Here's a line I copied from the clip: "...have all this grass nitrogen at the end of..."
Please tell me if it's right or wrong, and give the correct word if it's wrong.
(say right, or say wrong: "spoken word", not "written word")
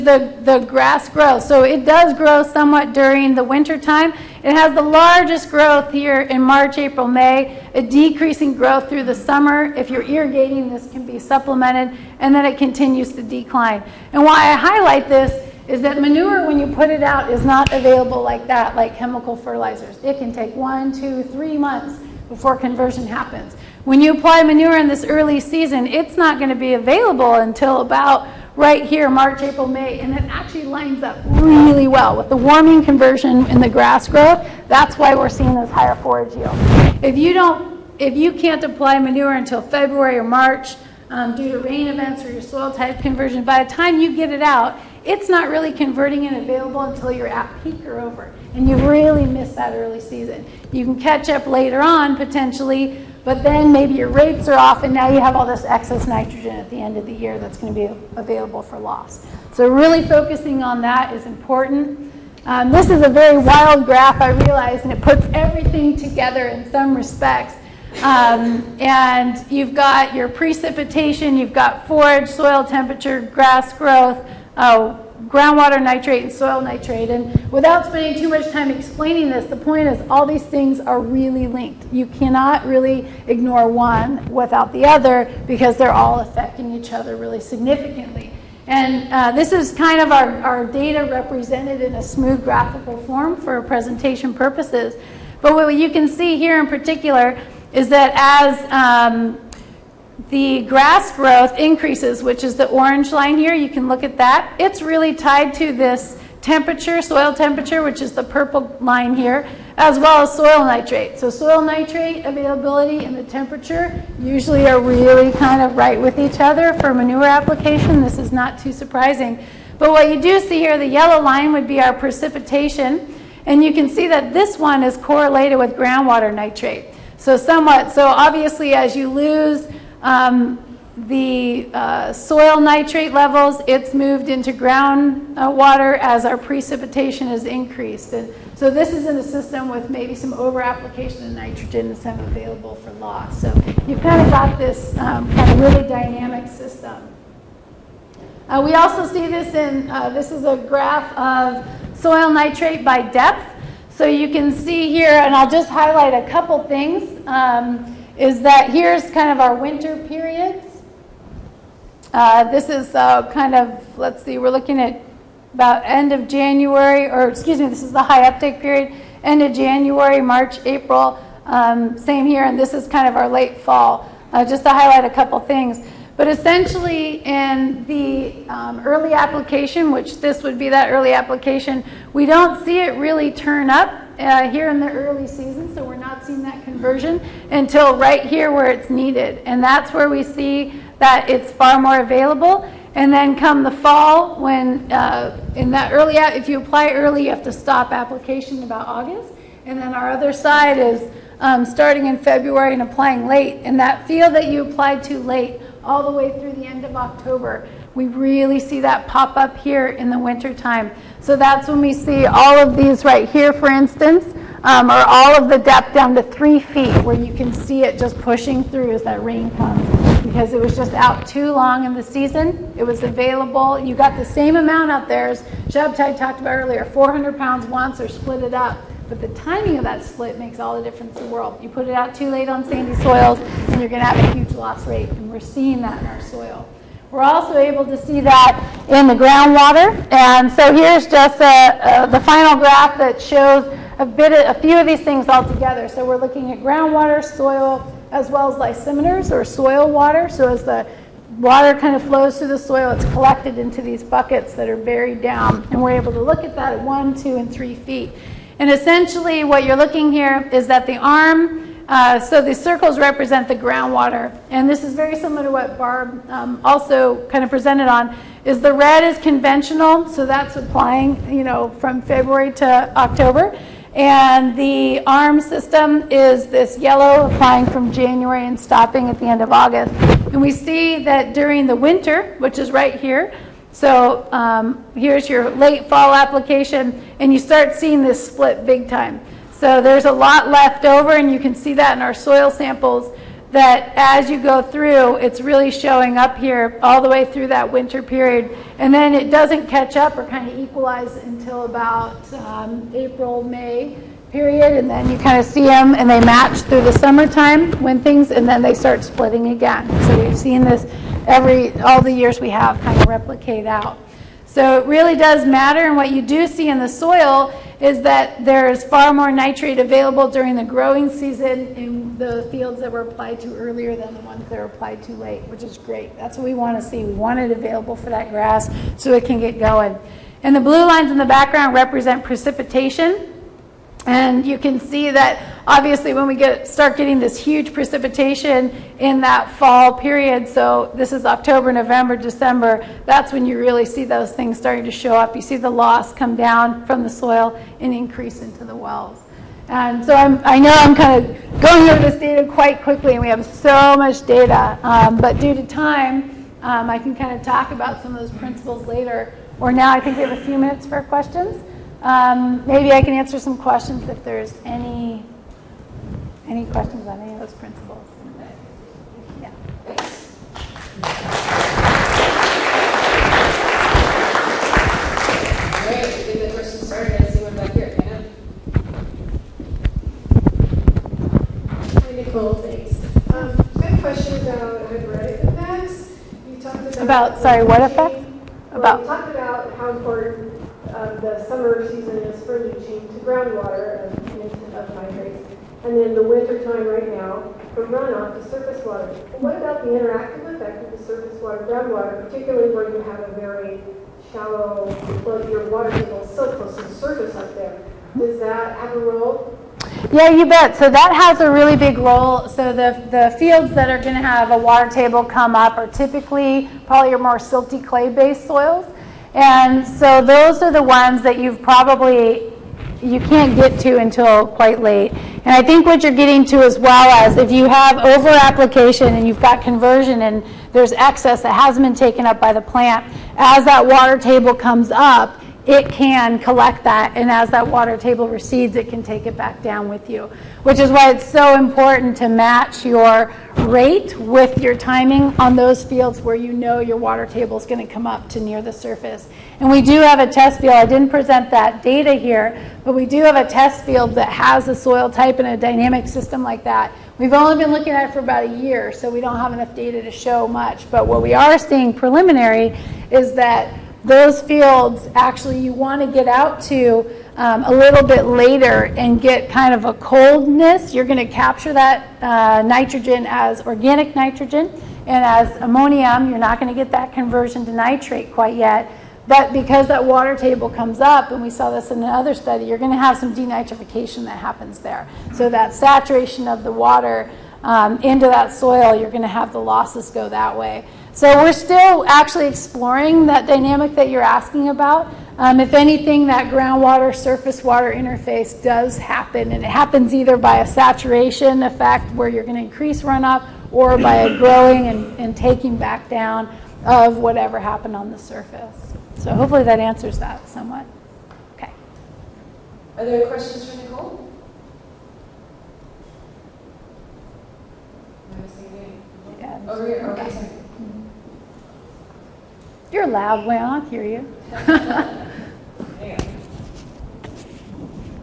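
wrong: "excess", not "grass".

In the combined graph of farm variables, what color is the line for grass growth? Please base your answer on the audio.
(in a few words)
Orange.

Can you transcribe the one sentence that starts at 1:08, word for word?
Um, and you've got your precipitation, you've got forage, soil temperature, grass growth, uh, groundwater nitrate and soil nitrate.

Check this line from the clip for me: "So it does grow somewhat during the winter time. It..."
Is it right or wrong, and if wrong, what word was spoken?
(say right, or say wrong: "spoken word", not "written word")
right.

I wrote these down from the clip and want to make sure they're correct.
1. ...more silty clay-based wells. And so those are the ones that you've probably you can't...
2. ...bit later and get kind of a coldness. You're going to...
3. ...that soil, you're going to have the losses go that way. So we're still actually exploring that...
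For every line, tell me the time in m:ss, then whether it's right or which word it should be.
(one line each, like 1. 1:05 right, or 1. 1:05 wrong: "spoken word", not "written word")
1. 6:57 wrong: "soils", not "wells"
2. 7:48 right
3. 8:08 right.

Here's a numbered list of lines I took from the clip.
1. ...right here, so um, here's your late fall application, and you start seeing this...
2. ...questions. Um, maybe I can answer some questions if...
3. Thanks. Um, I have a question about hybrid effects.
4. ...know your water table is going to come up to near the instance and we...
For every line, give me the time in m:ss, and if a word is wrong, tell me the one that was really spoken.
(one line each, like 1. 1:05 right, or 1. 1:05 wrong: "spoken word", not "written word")
1. 4:42 right
2. 6:01 right
3. 6:22 right
4. 7:26 wrong: "surface", not "instance".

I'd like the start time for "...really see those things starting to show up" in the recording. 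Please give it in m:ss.
5:43.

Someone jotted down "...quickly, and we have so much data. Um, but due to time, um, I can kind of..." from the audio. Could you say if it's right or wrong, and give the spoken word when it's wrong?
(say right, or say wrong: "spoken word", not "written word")
right.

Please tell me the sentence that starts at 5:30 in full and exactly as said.
And the blue lines in the background represent precipitation.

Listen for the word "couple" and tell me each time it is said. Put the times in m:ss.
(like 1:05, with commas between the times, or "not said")
2:36, 2:55.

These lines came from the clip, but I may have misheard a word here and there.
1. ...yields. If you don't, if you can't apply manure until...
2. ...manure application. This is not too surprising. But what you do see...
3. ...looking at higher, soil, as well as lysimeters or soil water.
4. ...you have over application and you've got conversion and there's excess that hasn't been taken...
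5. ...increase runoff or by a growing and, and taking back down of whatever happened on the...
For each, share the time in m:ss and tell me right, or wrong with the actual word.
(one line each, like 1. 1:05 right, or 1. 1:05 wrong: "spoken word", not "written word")
1. 0:36 right
2. 1:56 right
3. 4:06 wrong: "groundwater", not "higher"
4. 7:07 right
5. 8:22 right.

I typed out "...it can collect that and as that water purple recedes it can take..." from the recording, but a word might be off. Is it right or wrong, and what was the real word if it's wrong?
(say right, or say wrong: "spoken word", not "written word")
wrong: "table", not "purple".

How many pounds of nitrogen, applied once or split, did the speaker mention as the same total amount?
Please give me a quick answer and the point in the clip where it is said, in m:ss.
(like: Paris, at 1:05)
400, at 3:46.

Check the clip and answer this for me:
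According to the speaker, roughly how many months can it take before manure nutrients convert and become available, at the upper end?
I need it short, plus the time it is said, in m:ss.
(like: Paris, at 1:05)
3 months, at 0:21.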